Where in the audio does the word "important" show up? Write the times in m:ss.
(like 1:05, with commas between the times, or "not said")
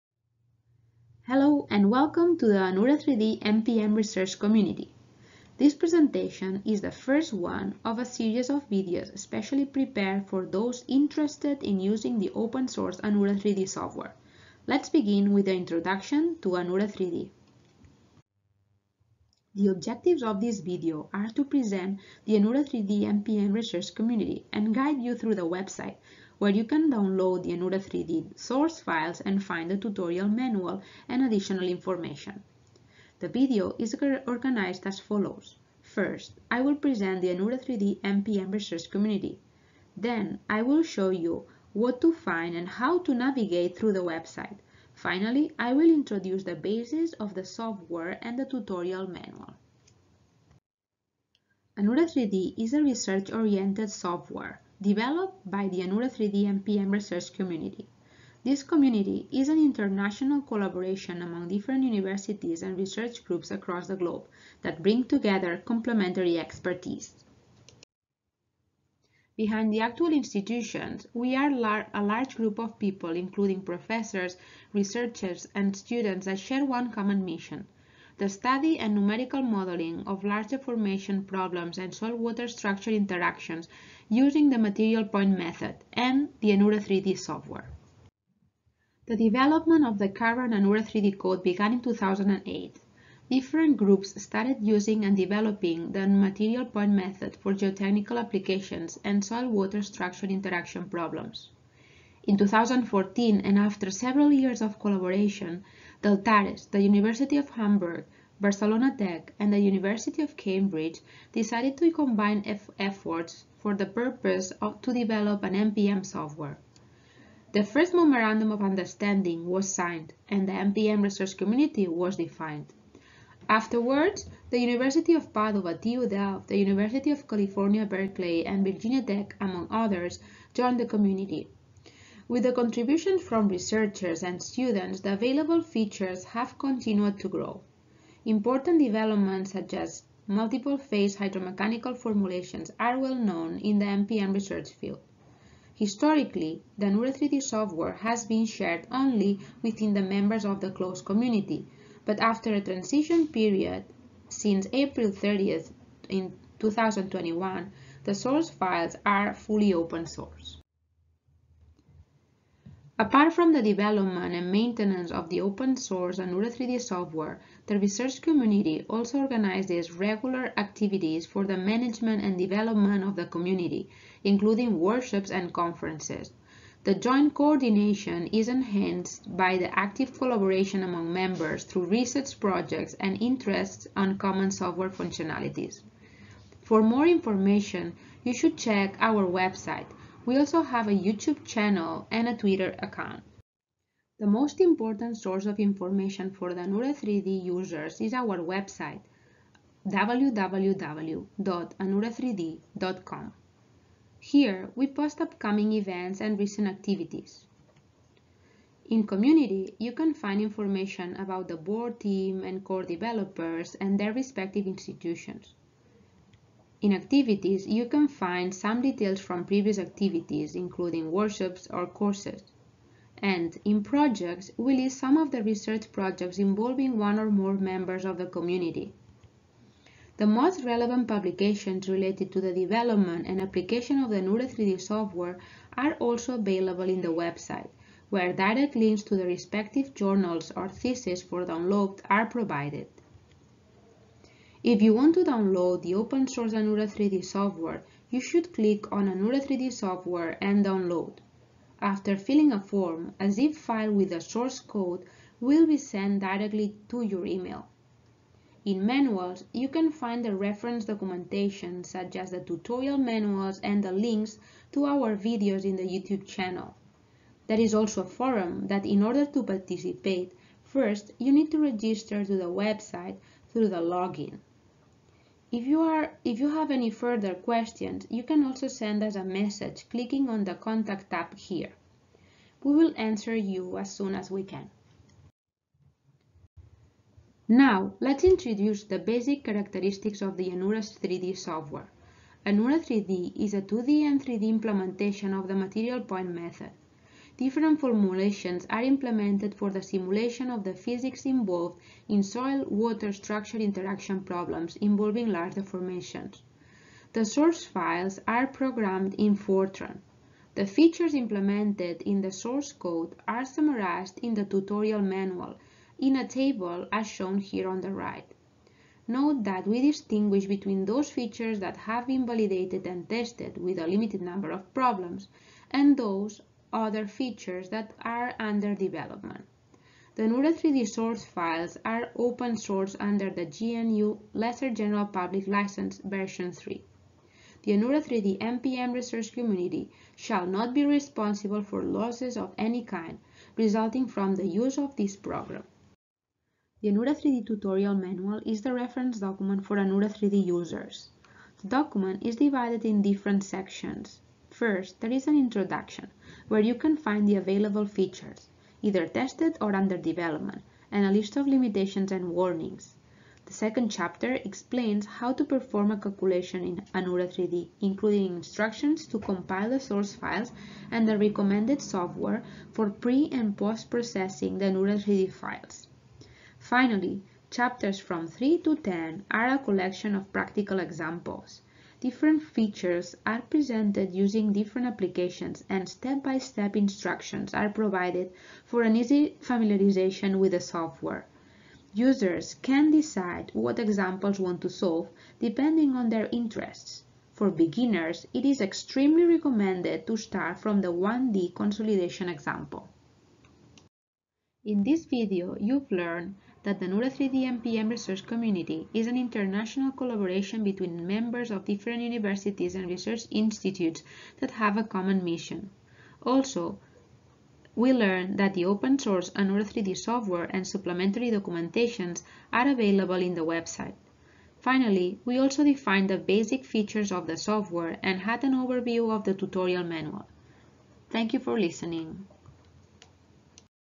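2:18, 3:14.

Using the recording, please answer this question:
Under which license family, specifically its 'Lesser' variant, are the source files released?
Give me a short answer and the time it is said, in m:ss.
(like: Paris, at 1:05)
GNU Lesser General Public License, at 5:33.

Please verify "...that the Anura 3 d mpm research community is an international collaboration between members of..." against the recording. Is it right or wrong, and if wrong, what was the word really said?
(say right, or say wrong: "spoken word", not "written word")
right.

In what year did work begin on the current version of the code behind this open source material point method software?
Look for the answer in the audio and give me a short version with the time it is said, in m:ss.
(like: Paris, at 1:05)
2008, at 1:31.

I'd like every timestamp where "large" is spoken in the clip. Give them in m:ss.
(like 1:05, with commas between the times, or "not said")
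1:12, 1:20, 5:05.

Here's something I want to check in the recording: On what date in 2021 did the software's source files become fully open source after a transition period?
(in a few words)
April 30th.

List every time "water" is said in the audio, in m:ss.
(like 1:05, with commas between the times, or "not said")
1:22, 1:39, 5:02.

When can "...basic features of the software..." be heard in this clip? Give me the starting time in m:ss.
7:06.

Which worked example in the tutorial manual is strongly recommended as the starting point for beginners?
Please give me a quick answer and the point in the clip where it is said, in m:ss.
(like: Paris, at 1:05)
1D consolidation, at 6:40.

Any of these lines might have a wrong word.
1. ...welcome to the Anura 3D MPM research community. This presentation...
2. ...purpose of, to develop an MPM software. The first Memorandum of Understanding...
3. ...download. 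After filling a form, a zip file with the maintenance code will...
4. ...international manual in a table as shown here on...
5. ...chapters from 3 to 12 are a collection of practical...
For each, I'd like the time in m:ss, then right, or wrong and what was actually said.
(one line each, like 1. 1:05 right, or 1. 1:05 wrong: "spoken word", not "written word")
1. 0:01 right
2. 1:53 right
3. 4:10 wrong: "source", not "maintenance"
4. 5:14 wrong: "tutorial", not "international"
5. 6:17 wrong: "10", not "12".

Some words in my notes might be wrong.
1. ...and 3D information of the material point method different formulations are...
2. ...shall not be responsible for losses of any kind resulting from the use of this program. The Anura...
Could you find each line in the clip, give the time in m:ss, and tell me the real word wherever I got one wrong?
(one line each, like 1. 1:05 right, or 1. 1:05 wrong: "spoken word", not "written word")
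1. 4:54 wrong: "implementation", not "information"
2. 5:40 right.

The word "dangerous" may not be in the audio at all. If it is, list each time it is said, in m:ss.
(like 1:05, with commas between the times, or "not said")
not said.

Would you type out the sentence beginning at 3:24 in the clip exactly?
Here, we post upcoming events and recent activities.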